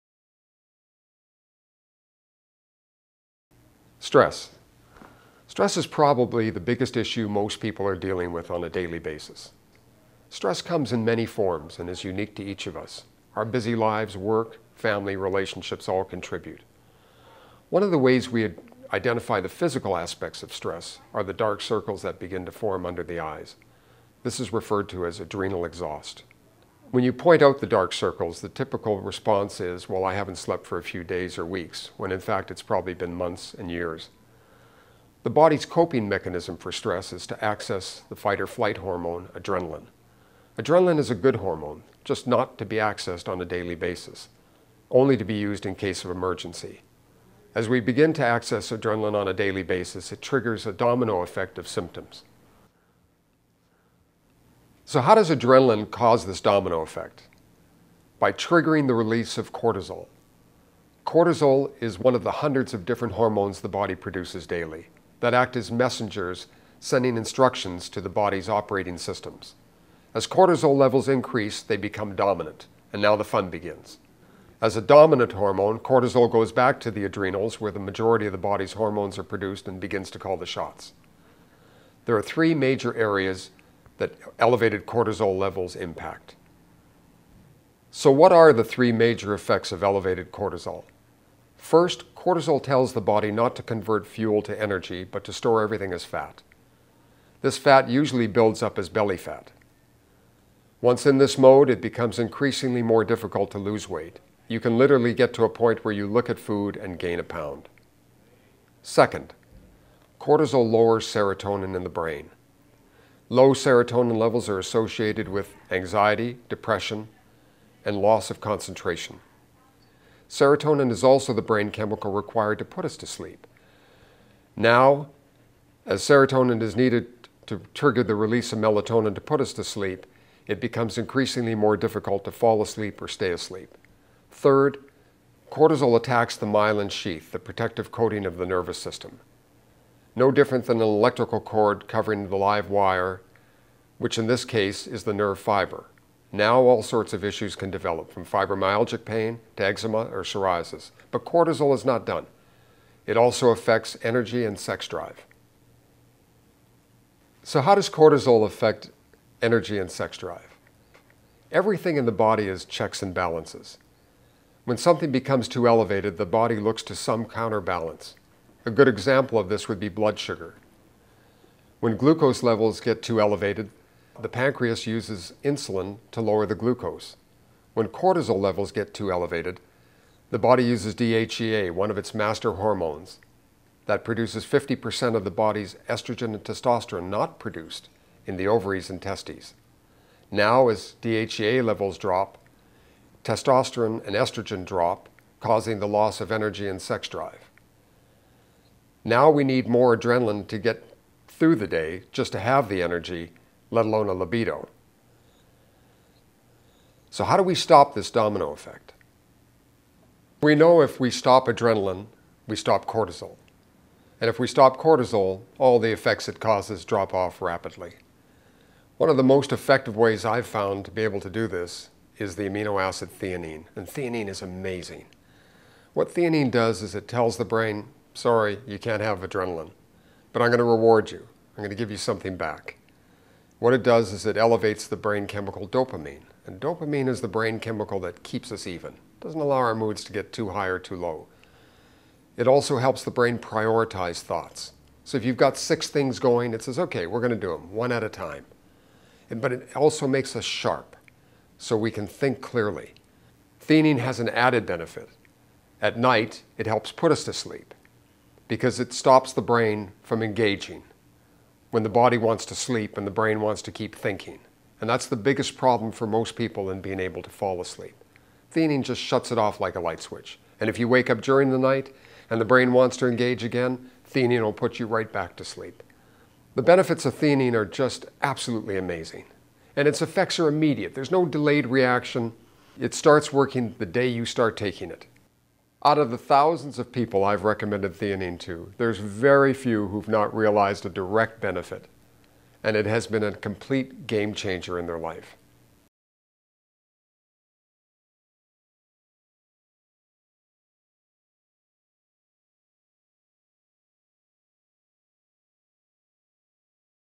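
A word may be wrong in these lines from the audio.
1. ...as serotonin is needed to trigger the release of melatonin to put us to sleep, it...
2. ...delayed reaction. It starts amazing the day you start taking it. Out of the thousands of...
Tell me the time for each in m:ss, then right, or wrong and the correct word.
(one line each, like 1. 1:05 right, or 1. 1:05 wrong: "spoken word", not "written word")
1. 2:05 right
2. 4:41 wrong: "working", not "amazing".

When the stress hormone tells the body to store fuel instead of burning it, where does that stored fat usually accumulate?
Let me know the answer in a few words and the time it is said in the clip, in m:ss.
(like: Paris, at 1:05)
belly fat, at 1:38.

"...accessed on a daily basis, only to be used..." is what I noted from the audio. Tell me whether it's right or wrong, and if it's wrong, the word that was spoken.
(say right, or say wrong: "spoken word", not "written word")
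right.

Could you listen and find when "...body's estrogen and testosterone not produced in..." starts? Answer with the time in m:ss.
3:05.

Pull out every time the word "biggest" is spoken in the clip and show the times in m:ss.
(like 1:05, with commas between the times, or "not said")
0:06, 4:25.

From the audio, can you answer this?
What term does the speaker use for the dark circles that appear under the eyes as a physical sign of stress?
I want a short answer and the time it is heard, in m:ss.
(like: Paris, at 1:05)
adrenal exhaust, at 0:25.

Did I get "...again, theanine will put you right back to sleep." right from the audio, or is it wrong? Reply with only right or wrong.
right.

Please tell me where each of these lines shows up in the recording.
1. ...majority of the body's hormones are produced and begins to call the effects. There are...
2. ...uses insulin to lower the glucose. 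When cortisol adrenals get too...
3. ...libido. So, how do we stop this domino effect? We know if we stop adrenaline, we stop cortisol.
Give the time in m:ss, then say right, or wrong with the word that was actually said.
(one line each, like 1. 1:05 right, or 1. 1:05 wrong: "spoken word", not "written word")
1. 1:17 wrong: "shots", not "effects"
2. 2:54 wrong: "levels", not "adrenals"
3. 3:24 right.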